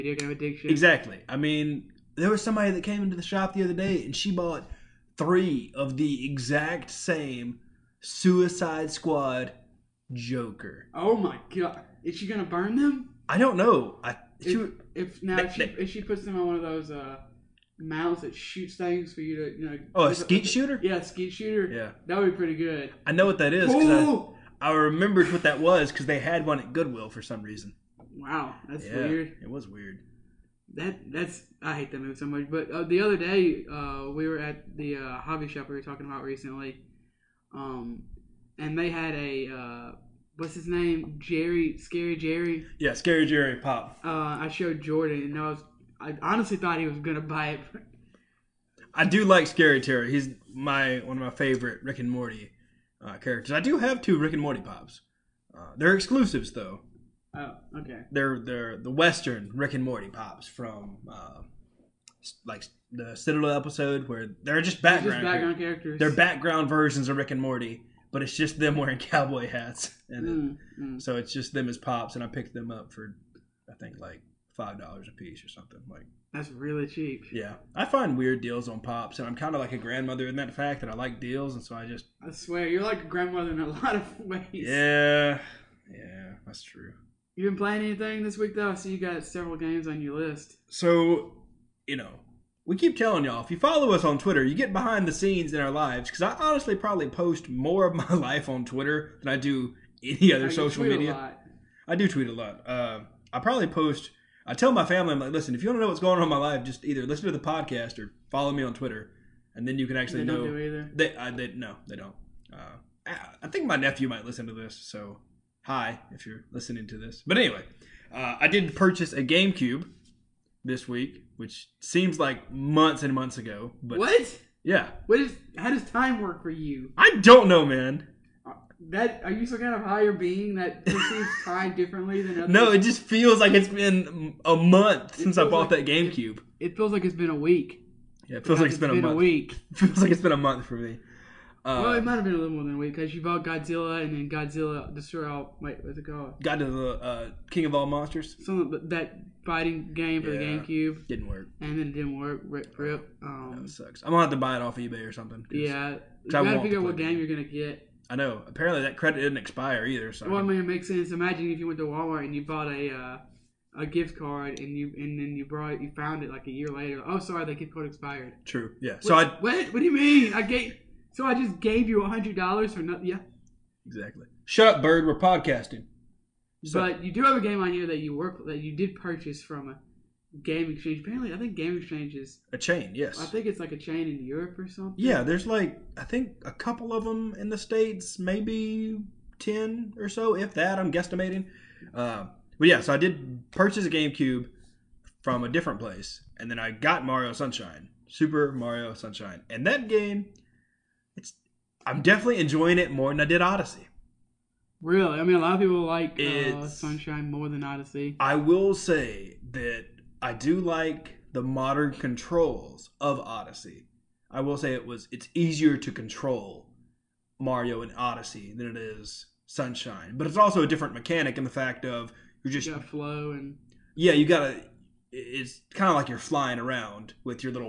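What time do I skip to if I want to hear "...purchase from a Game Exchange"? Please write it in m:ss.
2:58.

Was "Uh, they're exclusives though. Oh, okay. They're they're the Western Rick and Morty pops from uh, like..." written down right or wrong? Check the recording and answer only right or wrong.
right.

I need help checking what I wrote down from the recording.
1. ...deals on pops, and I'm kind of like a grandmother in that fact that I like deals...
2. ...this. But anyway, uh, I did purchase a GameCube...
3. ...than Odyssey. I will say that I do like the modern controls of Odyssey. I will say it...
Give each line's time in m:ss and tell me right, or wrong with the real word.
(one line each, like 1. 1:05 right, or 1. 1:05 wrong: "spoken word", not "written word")
1. 1:18 right
2. 1:56 right
3. 3:27 right.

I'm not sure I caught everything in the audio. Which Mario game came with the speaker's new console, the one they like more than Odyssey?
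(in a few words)
Super Mario Sunshine.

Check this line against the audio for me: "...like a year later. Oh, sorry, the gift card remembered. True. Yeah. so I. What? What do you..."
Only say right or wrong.
wrong.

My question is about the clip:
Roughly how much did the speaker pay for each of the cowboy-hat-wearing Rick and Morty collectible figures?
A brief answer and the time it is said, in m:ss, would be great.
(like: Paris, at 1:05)
$5, at 1:14.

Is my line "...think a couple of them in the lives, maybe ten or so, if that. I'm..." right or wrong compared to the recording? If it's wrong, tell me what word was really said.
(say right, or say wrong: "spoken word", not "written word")
wrong: "states", not "lives".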